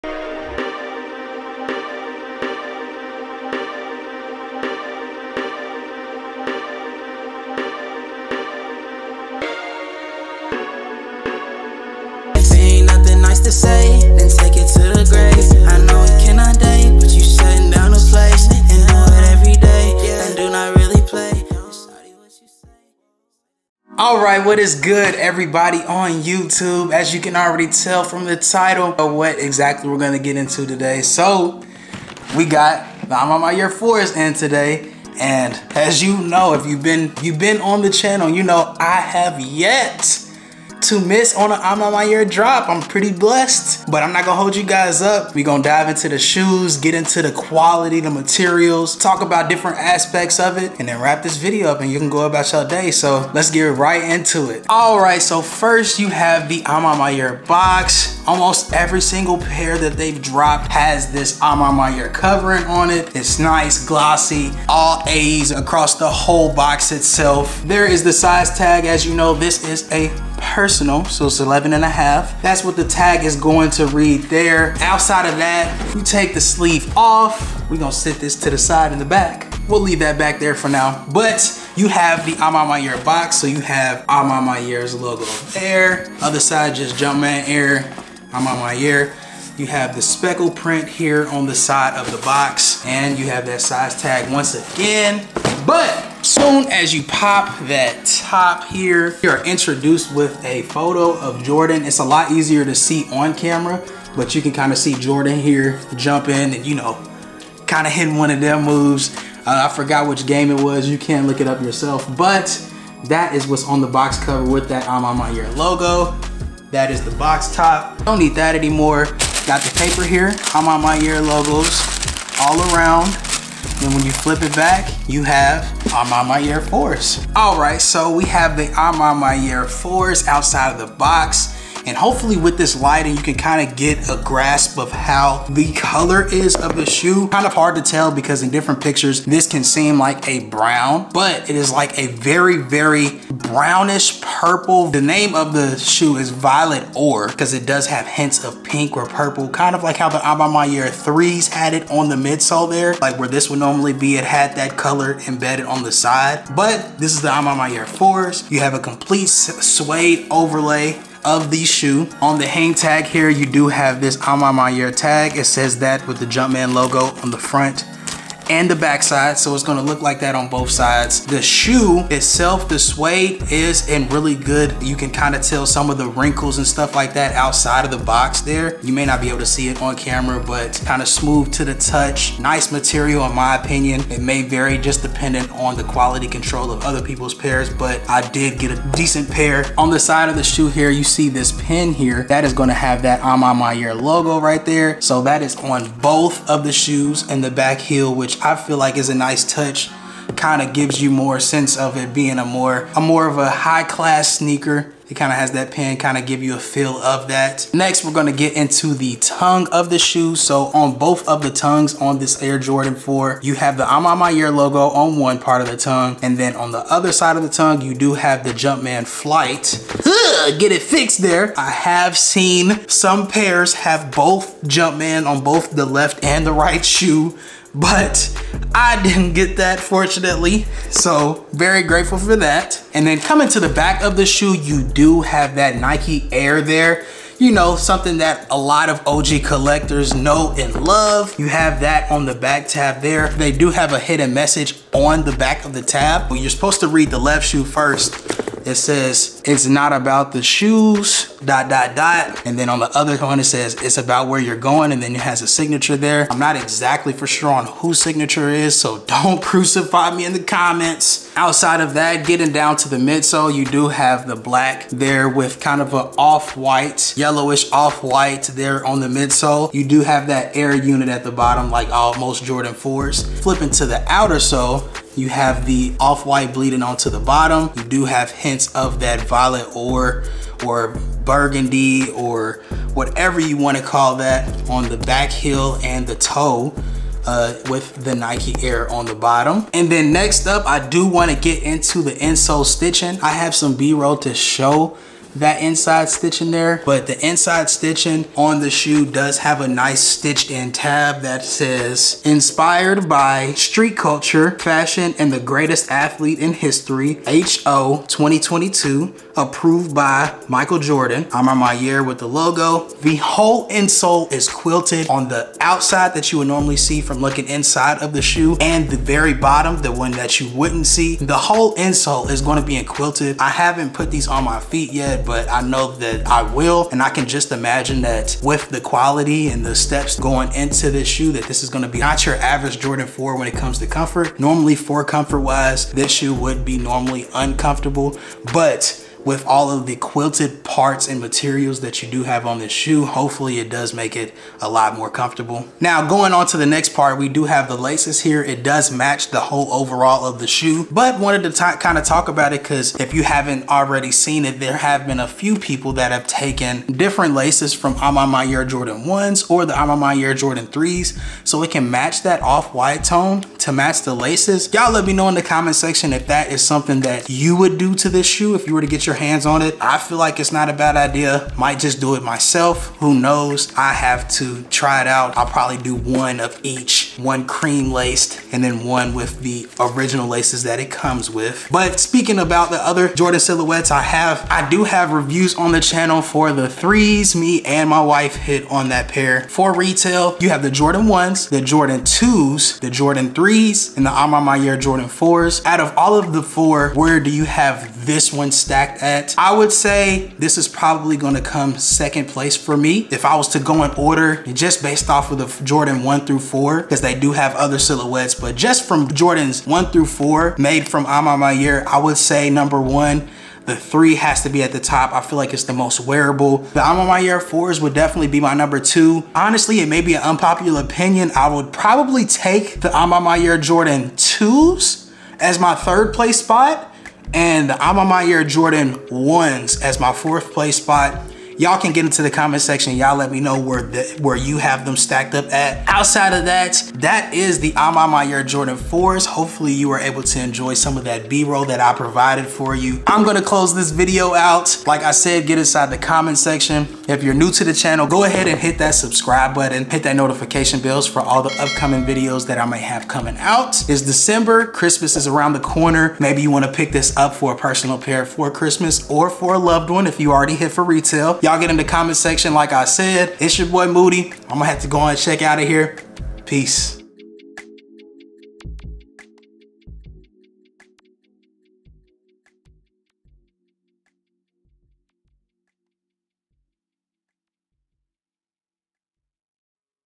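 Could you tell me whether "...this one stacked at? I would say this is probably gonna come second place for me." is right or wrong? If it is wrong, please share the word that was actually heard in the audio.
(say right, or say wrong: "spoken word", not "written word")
right.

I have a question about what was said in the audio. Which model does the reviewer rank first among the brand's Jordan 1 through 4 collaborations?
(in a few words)
Jordan 3.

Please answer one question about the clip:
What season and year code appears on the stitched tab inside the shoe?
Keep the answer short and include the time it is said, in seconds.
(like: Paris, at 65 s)
HO 2022, at 307 s.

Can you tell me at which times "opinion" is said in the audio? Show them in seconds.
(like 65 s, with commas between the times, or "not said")
183 s, 420 s.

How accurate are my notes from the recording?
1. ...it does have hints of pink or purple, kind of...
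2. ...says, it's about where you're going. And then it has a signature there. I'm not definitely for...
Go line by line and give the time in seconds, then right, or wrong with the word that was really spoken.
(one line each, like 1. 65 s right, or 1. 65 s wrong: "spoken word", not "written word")
1. 147 s right
2. 253 s wrong: "exactly", not "definitely".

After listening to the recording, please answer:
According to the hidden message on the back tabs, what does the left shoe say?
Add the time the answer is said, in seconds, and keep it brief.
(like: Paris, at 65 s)
It's not about the shoes, at 249 s.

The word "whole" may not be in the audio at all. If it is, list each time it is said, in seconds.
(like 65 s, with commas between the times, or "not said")
66 s, 313 s, 321 s, 349 s.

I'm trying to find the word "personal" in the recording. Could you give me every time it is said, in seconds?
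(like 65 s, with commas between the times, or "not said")
70 s, 457 s.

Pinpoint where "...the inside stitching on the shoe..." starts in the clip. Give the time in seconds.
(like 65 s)
297 s.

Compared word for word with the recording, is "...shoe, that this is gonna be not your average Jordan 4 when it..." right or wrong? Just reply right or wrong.
right.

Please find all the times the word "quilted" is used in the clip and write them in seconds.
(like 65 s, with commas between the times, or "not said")
314 s, 322 s, 339 s.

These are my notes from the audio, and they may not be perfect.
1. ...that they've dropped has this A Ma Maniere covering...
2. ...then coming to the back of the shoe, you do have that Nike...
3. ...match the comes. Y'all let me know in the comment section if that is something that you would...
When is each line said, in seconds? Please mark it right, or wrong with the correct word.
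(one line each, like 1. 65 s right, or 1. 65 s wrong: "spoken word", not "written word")
1. 59 s right
2. 233 s right
3. 363 s wrong: "laces", not "comes".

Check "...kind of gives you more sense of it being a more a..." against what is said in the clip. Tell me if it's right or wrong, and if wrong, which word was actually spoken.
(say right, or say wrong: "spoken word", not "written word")
right.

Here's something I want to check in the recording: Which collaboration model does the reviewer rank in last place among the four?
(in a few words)
Jordan 1s.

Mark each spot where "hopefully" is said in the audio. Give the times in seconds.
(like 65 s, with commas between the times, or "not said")
131 s, 343 s, 439 s.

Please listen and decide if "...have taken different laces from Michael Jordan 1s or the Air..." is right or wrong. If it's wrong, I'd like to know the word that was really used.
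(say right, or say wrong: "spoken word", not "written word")
wrong: "Air", not "Michael".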